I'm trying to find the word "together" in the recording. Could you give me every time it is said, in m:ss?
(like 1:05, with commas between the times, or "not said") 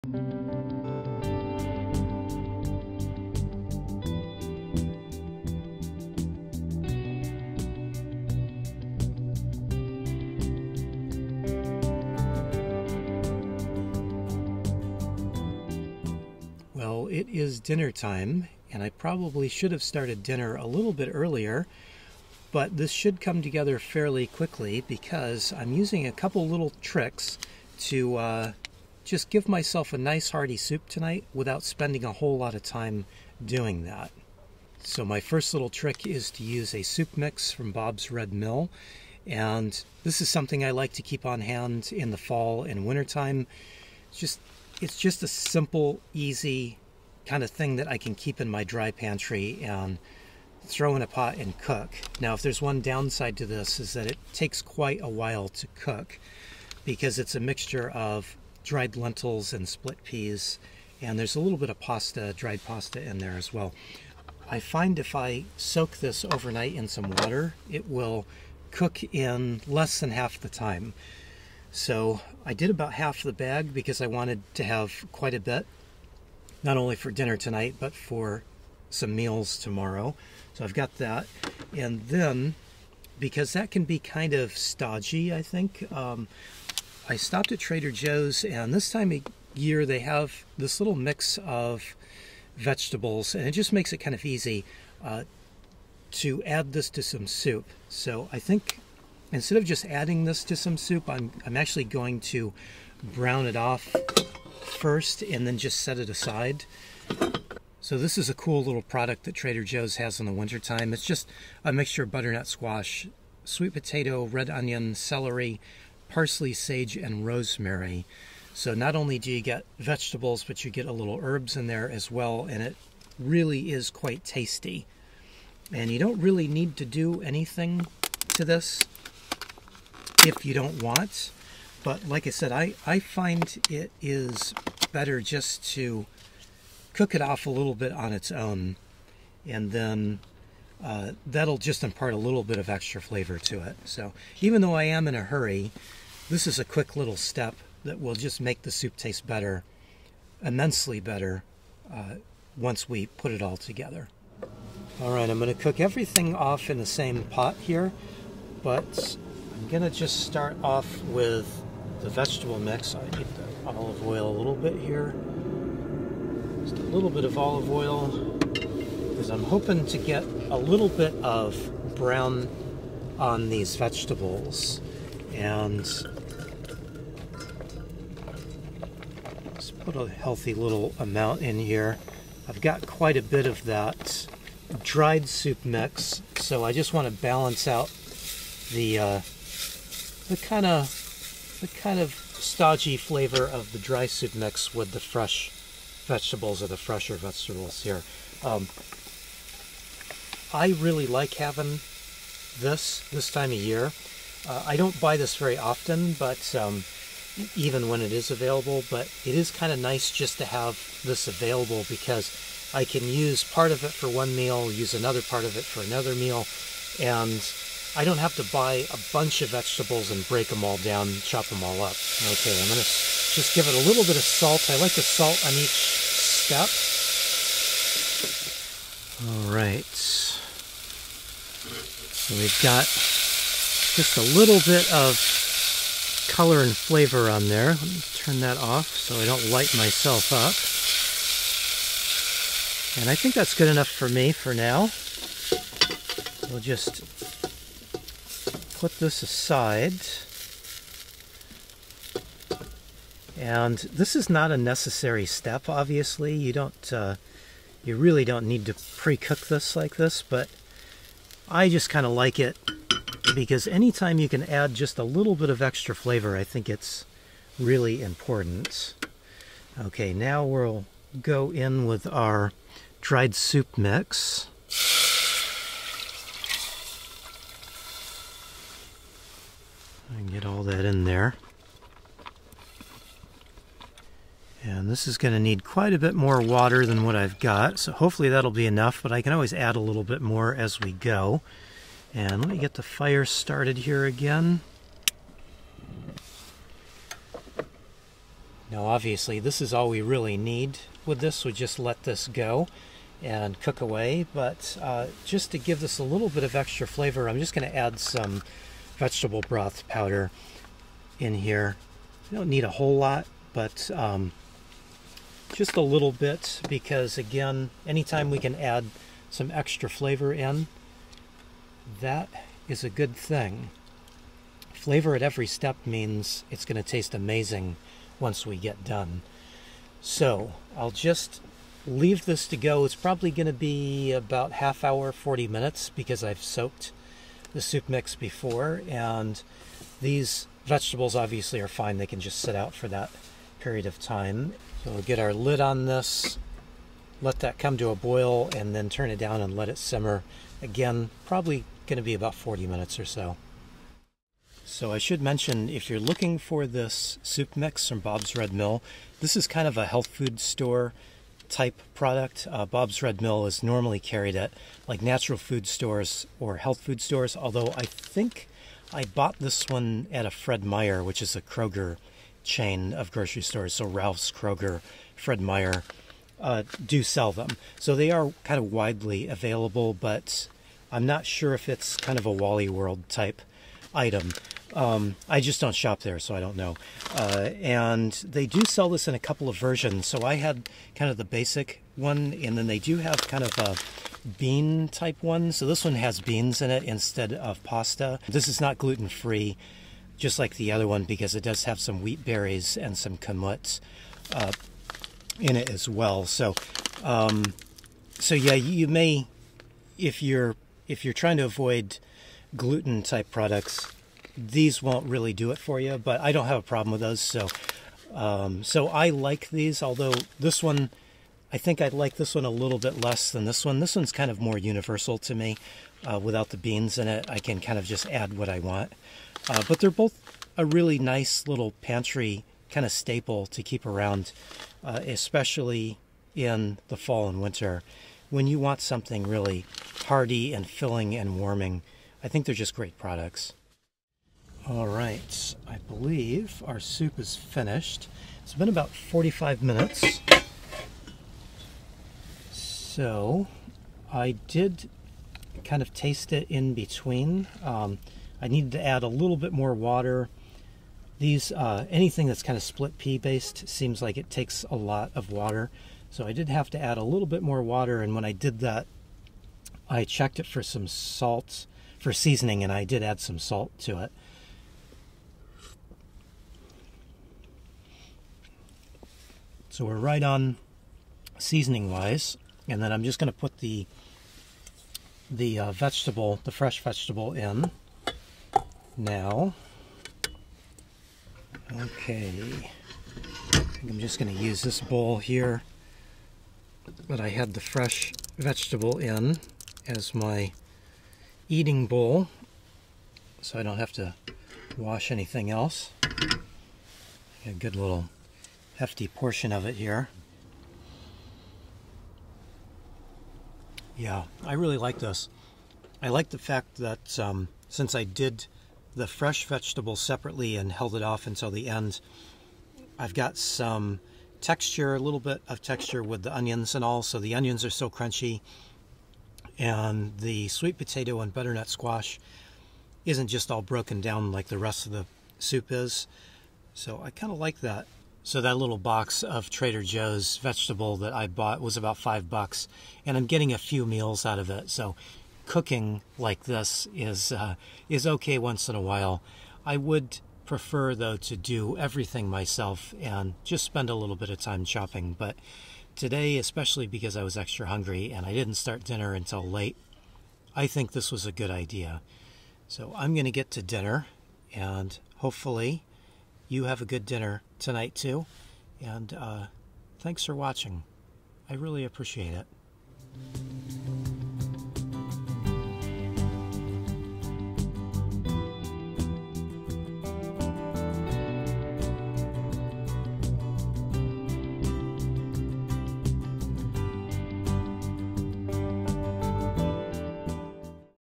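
0:23, 2:33.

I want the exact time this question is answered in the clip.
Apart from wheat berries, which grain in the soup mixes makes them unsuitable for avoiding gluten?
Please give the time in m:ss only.
6:43.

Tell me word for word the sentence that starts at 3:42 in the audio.
Okay, I'm gonna just give it a little bit of salt.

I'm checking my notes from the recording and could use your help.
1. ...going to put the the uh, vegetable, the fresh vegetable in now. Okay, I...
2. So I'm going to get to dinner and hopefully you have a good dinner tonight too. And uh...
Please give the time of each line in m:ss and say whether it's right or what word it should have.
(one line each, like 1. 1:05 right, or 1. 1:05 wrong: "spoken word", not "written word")
1. 8:03 right
2. 9:22 right.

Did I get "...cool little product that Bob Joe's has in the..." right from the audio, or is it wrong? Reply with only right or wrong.
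wrong.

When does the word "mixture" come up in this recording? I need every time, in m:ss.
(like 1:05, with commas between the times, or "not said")
0:57, 1:51.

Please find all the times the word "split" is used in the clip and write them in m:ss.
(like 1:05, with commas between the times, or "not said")
0:59, 7:42.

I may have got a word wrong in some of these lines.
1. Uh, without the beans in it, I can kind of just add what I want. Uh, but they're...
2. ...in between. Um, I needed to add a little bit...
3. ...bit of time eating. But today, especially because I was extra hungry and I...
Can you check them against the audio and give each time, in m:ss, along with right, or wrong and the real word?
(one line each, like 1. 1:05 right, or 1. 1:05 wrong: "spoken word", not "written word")
1. 7:06 right
2. 7:36 right
3. 9:14 wrong: "shopping", not "eating".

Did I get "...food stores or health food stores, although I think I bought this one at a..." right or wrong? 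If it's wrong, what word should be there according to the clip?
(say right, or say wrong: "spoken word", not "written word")
right.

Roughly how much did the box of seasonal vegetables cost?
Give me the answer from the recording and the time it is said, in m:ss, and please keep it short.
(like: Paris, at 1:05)
$5, at 9:01.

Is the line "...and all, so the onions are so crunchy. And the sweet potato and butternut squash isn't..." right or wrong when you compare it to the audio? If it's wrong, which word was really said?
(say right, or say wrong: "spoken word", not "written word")
right.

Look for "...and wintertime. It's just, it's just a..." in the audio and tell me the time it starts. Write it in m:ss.
0:42.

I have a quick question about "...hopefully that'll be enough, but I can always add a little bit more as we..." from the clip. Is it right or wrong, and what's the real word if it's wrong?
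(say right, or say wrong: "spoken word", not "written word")
right.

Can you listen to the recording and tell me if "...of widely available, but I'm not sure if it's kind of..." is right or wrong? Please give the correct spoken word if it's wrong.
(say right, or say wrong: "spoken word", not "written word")
right.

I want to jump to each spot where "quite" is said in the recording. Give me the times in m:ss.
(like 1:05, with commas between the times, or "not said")
0:54, 1:15, 2:03, 3:02, 4:45.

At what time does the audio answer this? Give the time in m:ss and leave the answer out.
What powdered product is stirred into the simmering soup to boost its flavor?
5:08.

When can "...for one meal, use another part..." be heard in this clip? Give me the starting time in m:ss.
3:33.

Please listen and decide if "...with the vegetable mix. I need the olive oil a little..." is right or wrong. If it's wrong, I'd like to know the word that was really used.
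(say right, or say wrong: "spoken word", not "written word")
right.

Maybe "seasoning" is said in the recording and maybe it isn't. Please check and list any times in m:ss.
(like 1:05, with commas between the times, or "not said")
7:52, 8:01.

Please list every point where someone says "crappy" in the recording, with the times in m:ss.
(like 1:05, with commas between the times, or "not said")
not said.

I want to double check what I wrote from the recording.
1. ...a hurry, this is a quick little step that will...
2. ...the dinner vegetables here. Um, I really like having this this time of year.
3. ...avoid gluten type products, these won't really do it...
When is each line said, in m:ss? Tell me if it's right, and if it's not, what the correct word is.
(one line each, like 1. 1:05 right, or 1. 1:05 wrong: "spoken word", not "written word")
1. 2:25 right
2. 3:16 wrong: "fresher", not "dinner"
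3. 6:51 right.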